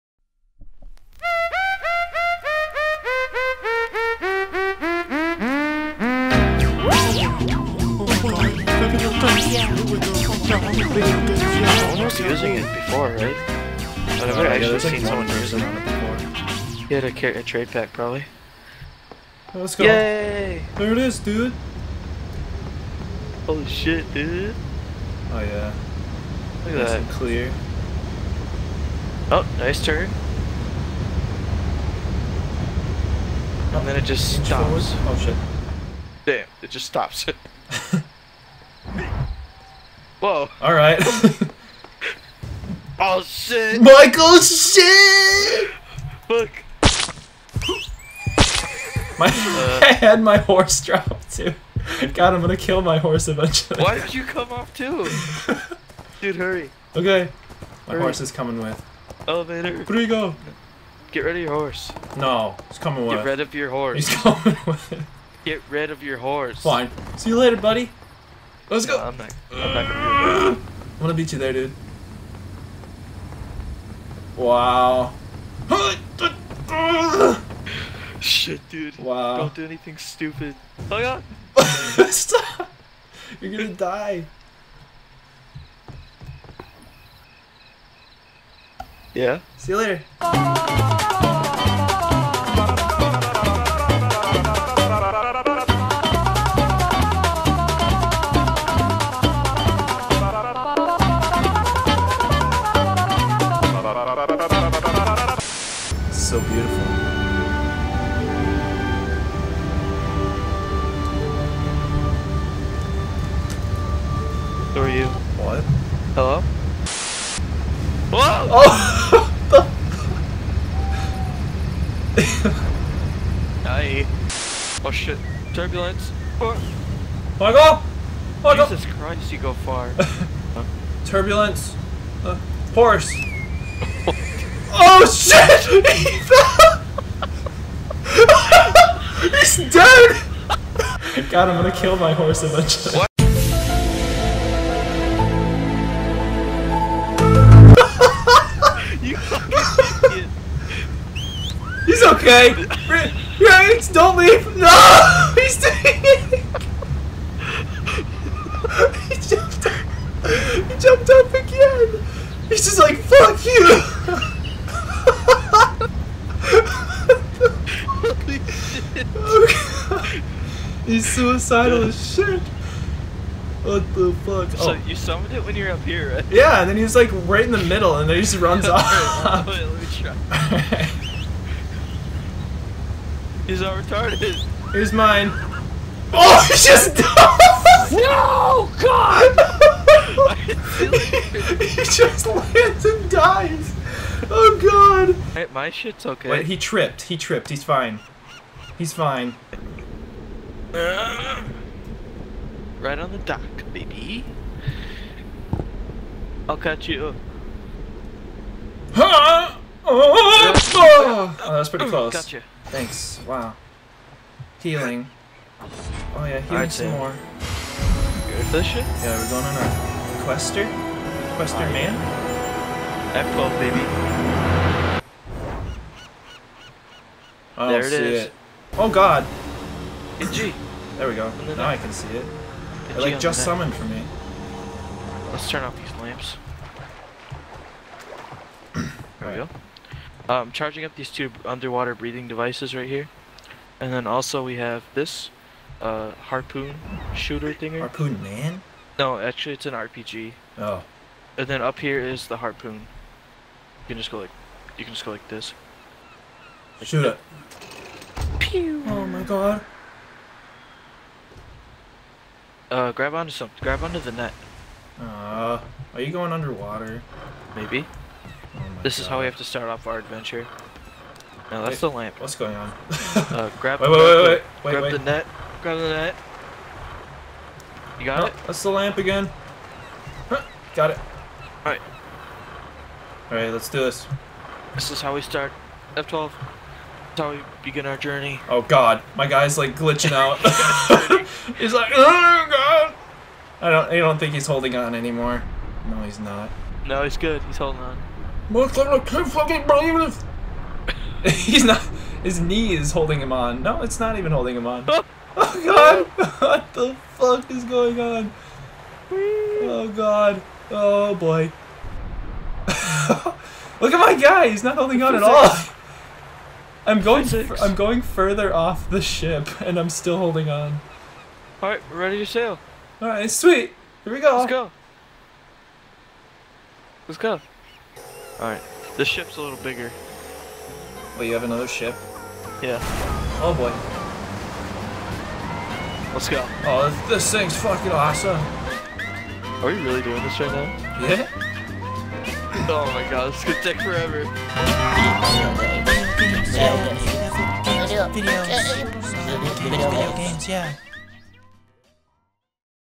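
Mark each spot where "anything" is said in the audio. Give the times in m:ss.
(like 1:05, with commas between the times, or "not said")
1:19.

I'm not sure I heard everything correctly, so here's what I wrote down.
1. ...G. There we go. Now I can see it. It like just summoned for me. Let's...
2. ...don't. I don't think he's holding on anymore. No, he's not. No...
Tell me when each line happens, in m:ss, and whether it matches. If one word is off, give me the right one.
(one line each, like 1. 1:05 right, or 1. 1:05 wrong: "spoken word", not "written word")
1. 3:50 right
2. 4:53 right.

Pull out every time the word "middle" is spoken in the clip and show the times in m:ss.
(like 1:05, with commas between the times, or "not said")
2:57.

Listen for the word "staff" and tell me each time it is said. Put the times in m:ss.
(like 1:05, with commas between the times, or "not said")
not said.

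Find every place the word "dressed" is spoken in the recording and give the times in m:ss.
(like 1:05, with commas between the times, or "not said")
not said.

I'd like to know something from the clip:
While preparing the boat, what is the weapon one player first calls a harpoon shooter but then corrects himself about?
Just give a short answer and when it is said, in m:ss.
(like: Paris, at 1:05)
RPG, at 4:09.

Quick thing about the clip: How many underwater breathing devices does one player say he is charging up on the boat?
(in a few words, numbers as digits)
2.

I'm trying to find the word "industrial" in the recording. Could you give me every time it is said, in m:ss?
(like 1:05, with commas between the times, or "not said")
not said.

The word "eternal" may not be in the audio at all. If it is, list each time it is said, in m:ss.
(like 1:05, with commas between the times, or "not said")
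not said.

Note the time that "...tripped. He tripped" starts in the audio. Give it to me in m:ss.
3:16.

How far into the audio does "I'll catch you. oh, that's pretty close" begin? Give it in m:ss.
3:26.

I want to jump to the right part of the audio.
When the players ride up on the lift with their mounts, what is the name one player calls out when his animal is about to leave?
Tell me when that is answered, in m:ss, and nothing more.
2:33.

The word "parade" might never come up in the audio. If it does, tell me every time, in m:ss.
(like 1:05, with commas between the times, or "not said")
not said.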